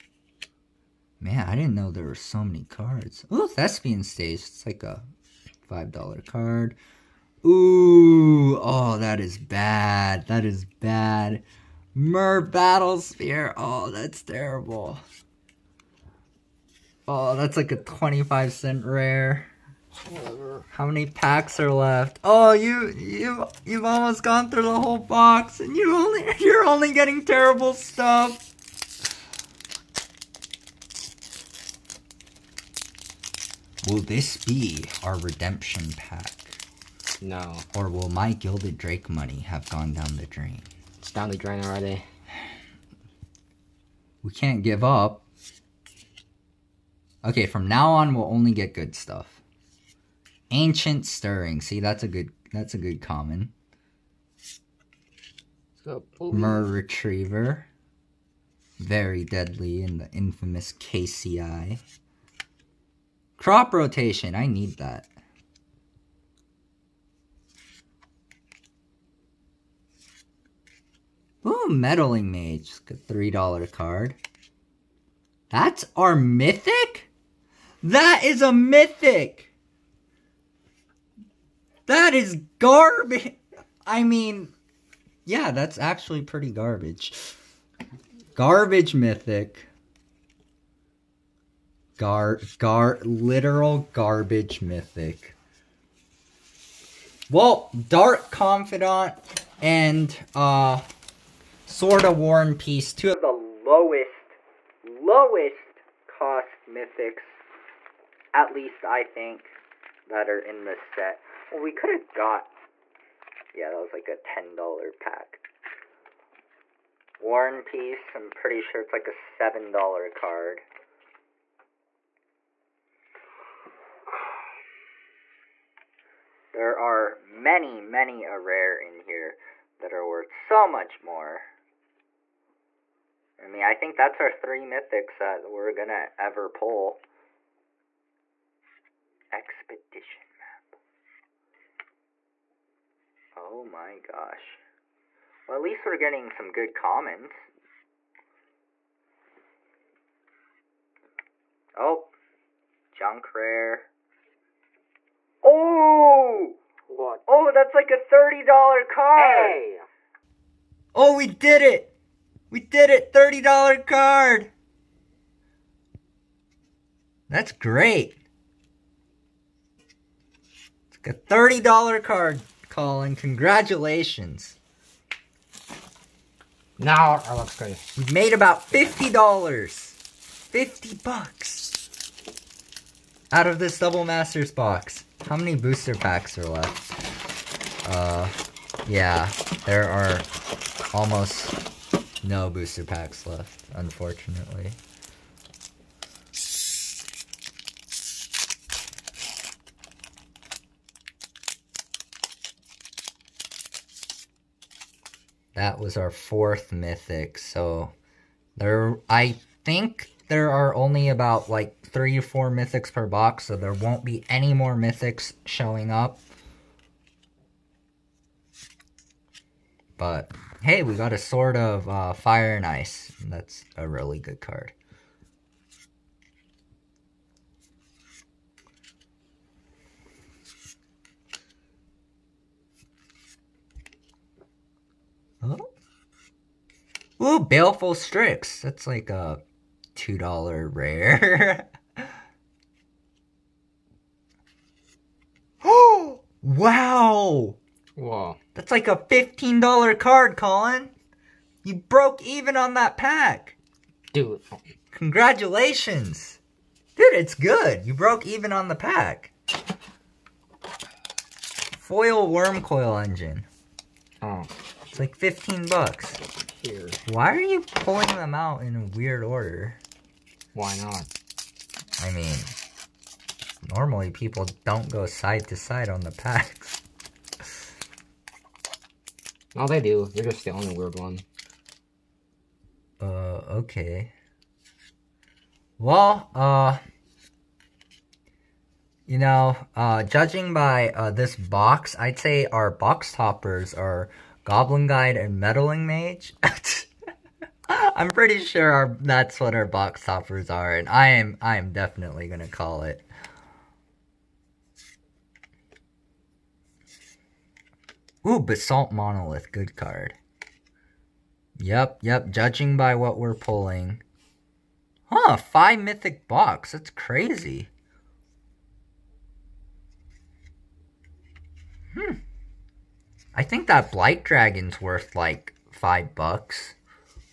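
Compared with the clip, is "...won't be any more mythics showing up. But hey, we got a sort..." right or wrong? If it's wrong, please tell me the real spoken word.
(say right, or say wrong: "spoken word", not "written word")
right.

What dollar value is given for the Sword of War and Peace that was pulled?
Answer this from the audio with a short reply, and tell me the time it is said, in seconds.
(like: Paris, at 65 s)
$7, at 119 s.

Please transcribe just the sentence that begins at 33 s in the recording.
Will this be our redemption pack?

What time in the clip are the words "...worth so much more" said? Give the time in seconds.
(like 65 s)
130 s.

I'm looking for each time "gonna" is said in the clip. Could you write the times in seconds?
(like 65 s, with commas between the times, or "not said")
135 s, 302 s.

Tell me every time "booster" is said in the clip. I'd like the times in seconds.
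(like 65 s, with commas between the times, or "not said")
185 s, 192 s.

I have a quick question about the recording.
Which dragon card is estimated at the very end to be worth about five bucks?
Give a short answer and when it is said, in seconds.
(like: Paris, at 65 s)
Blight Dragon, at 323 s.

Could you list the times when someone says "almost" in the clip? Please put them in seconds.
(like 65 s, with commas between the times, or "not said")
23 s, 190 s.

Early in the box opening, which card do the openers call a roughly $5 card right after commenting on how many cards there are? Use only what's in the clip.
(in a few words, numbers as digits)
Thespian Stage.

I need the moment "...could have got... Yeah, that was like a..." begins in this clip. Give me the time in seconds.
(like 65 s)
111 s.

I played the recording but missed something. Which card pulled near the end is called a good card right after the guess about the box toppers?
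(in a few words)
Basalt Monolith.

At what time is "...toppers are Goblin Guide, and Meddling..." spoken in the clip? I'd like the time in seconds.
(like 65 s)
293 s.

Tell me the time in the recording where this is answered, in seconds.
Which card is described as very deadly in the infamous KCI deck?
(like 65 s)
56 s.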